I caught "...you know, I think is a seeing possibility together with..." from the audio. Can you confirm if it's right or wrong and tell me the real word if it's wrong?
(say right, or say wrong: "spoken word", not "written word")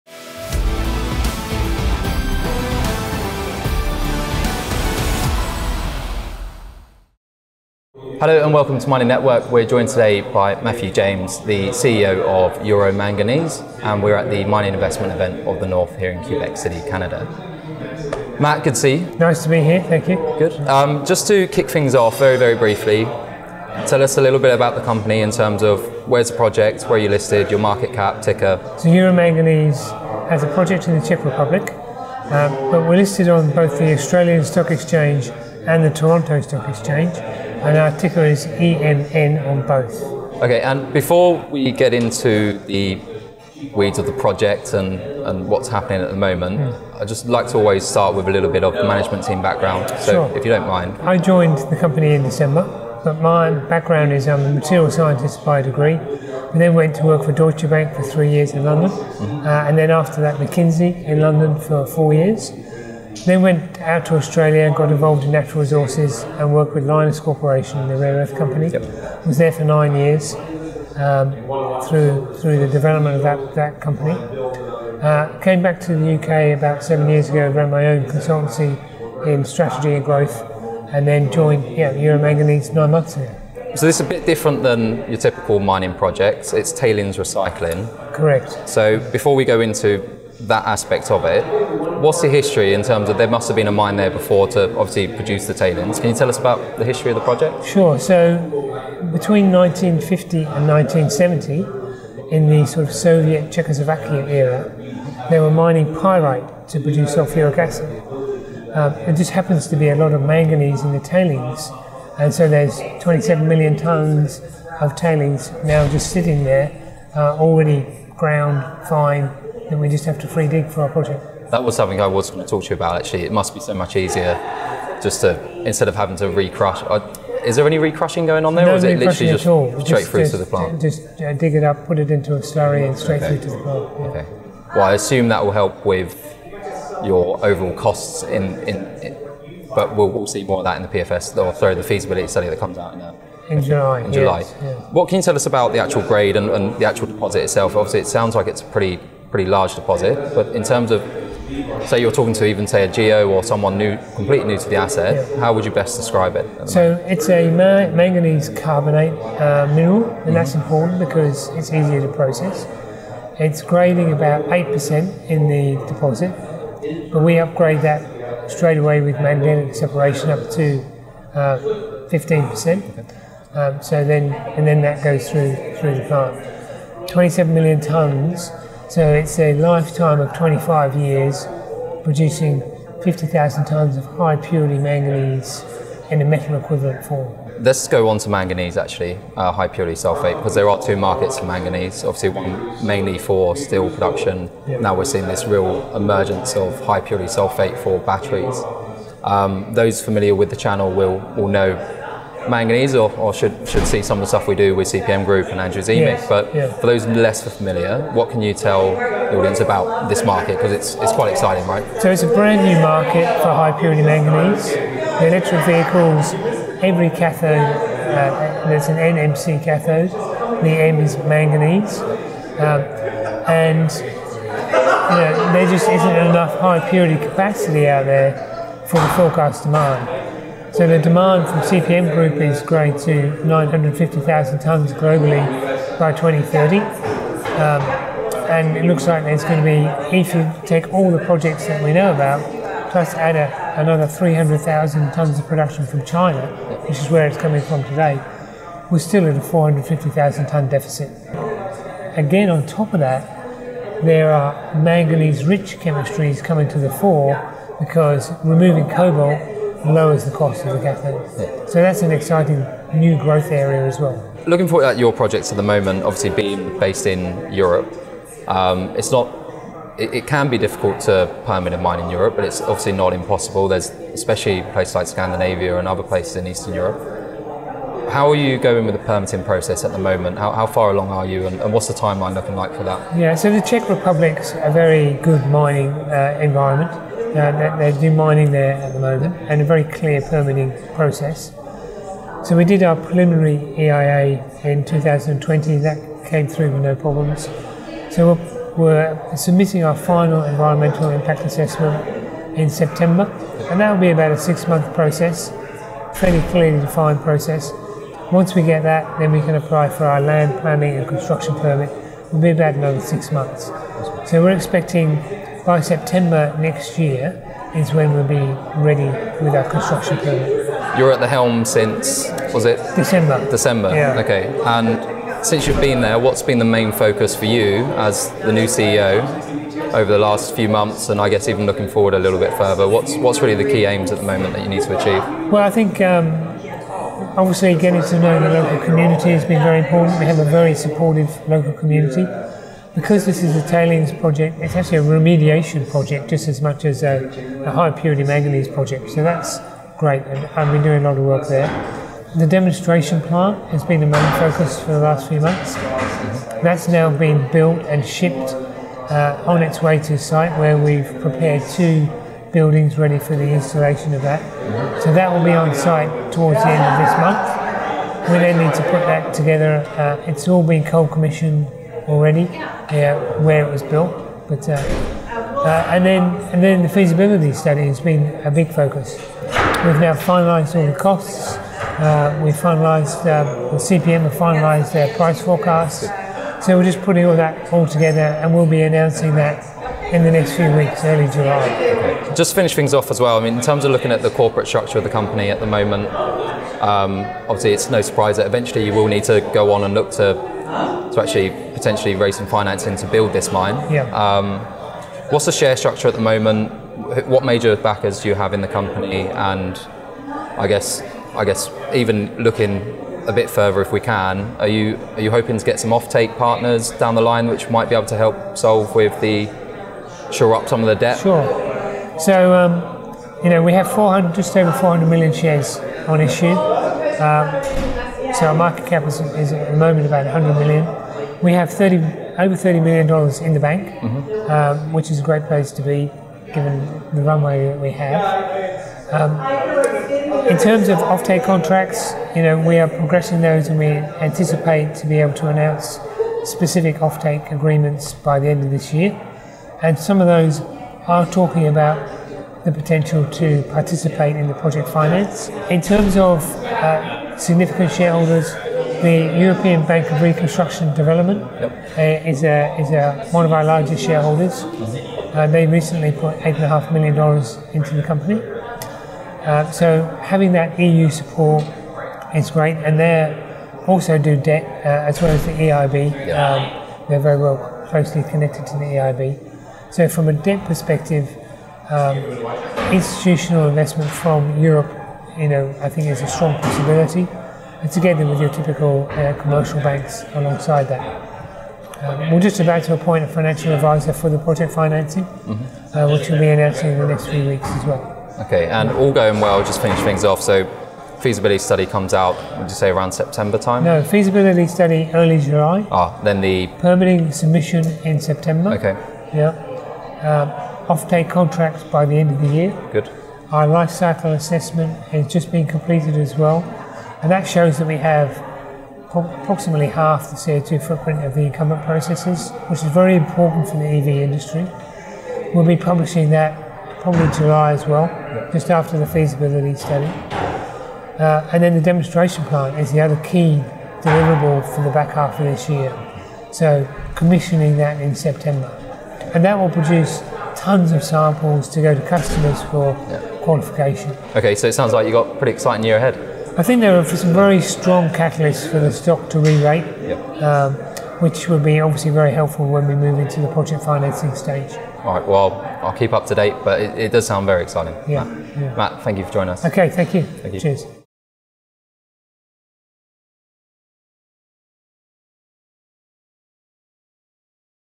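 wrong: "strong", not "seeing".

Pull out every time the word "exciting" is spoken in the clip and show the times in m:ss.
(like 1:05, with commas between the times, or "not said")
3:31, 4:22, 9:05, 9:17.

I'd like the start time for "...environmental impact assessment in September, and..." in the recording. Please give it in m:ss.
5:00.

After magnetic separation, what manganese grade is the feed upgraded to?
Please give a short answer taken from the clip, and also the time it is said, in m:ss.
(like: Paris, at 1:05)
15%, at 2:52.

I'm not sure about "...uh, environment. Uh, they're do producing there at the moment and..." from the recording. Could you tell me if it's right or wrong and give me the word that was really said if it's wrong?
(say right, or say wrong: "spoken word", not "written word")
wrong: "mining", not "producing".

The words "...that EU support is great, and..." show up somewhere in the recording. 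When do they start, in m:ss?
7:50.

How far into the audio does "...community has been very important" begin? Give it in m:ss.
5:38.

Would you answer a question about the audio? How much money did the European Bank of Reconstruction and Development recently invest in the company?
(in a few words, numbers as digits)
$8.5 million.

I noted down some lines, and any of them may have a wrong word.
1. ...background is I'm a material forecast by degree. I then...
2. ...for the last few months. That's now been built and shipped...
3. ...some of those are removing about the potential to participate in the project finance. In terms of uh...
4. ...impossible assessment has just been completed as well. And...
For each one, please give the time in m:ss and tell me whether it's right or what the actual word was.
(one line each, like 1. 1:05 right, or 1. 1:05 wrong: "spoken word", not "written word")
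1. 0:53 wrong: "scientist", not "forecast"
2. 5:54 right
3. 7:29 wrong: "talking", not "removing"
4. 8:33 wrong: "cycle", not "impossible".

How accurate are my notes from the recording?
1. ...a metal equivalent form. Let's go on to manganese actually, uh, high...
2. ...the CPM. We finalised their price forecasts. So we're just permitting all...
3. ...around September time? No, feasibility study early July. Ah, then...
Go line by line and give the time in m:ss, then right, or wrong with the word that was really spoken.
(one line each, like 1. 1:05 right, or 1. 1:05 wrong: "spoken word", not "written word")
1. 3:06 right
2. 6:23 wrong: "putting", not "permitting"
3. 8:22 right.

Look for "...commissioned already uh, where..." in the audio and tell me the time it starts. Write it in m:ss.
6:11.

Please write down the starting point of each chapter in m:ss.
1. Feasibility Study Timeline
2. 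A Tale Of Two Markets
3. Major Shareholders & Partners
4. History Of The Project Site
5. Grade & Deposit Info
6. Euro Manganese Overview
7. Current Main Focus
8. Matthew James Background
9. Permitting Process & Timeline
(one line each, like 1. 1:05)
1. 8:18
2. 3:07
3. 6:32
4. 1:23
5. 2:24
6. 0:20
7. 5:21
8. 0:40
9. 4:24.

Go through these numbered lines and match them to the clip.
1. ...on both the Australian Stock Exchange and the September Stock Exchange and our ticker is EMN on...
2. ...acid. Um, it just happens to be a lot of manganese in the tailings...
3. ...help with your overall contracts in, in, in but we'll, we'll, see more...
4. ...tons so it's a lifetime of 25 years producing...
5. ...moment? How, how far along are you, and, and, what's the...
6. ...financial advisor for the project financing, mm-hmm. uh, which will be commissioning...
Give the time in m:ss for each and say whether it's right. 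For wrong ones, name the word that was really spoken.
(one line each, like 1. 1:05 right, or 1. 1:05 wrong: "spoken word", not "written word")
1. 0:33 wrong: "Toronto", not "September"
2. 1:47 right
3. 2:15 wrong: "costs", not "contracts"
4. 2:57 right
5. 4:39 right
6. 8:13 wrong: "announcing", not "commissioning".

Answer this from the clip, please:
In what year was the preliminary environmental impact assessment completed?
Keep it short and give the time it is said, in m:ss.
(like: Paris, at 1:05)
2020, at 4:54.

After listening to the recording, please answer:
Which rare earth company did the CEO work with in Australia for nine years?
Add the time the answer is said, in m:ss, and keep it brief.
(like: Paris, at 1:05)
Lynas Corporation, at 1:06.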